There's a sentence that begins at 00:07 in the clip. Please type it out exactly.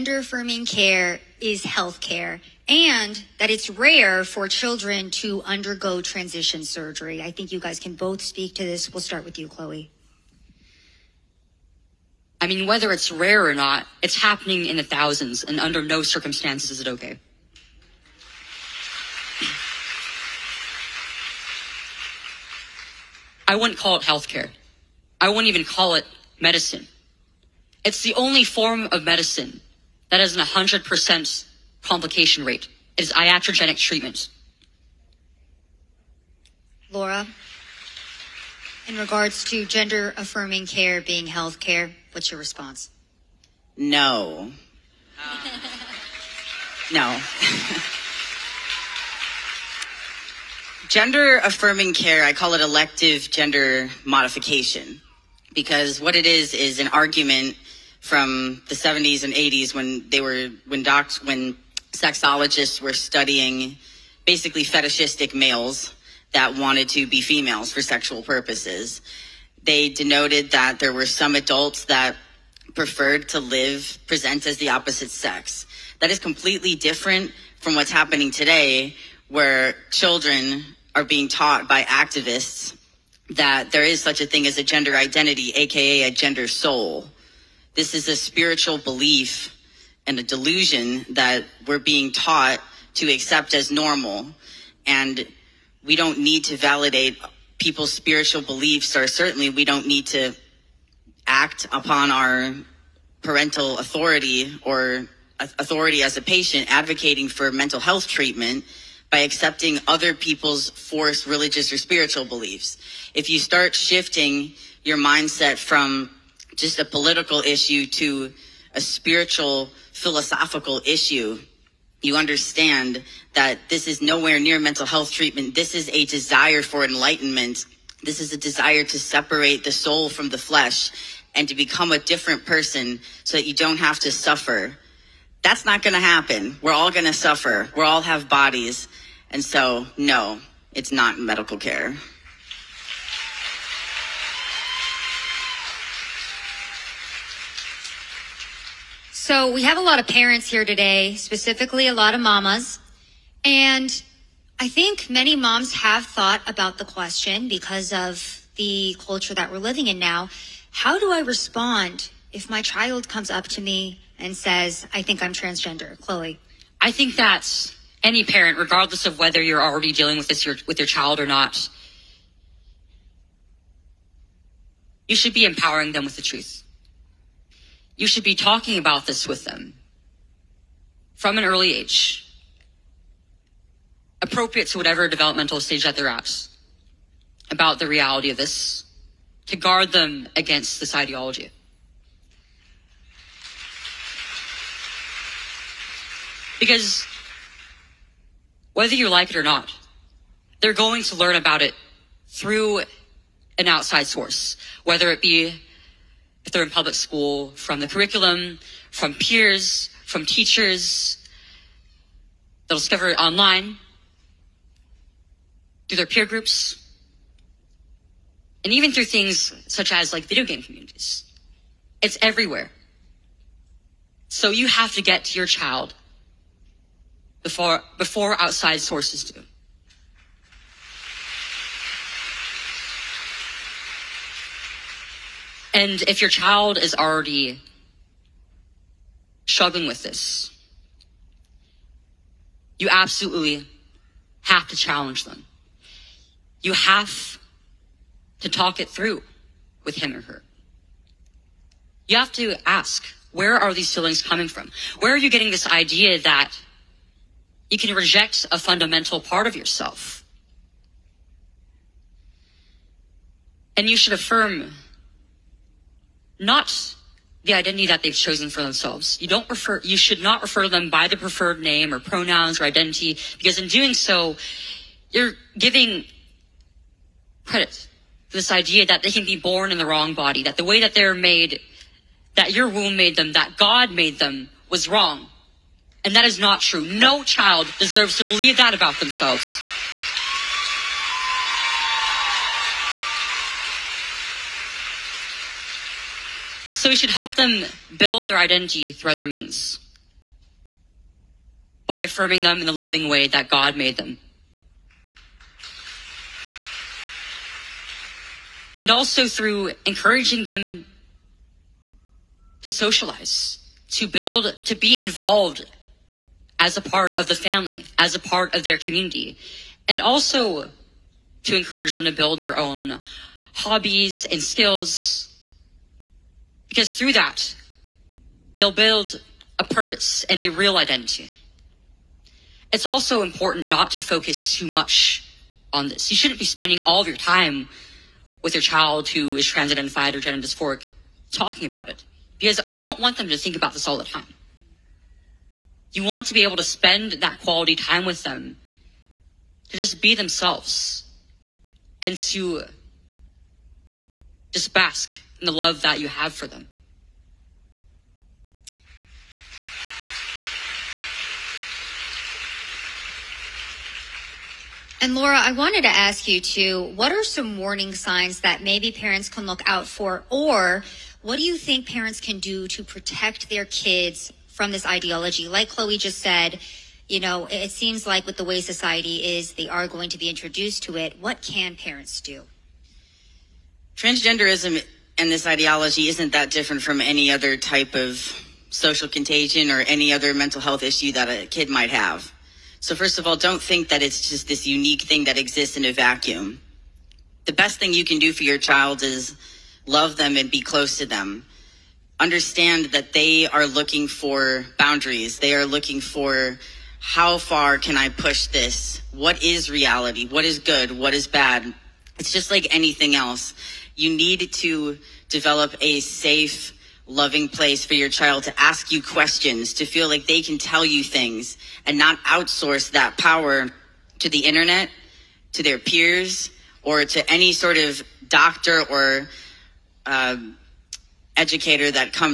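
I think you guys can both speak to this.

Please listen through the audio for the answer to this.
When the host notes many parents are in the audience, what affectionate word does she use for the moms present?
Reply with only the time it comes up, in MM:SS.
02:32.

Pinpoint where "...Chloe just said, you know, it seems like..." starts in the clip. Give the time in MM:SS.
06:15.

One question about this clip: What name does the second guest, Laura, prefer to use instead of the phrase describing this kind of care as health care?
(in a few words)
elective gender modification.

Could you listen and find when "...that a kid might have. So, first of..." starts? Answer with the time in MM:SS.
06:31.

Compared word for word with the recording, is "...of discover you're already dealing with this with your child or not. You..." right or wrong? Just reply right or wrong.
wrong.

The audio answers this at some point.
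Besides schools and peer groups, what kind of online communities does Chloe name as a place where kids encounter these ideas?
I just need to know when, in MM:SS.
03:40.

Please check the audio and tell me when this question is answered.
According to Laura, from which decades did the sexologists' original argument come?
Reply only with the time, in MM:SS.
00:58.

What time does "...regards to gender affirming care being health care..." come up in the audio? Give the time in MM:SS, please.
00:38.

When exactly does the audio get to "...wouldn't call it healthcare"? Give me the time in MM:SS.
00:23.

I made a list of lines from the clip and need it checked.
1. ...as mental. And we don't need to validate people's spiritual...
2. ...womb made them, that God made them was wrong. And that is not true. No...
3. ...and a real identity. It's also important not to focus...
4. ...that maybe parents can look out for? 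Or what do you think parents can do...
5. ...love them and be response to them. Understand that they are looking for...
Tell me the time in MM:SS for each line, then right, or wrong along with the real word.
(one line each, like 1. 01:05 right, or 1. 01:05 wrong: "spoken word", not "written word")
1. 01:33 wrong: "normal", not "mental"
2. 04:42 right
3. 05:30 right
4. 06:08 right
5. 06:39 wrong: "close", not "response".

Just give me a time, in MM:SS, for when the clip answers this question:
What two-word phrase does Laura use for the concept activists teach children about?
01:26.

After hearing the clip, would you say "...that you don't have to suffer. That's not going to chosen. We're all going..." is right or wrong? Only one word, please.
wrong.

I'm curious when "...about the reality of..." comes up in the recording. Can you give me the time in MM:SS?
03:07.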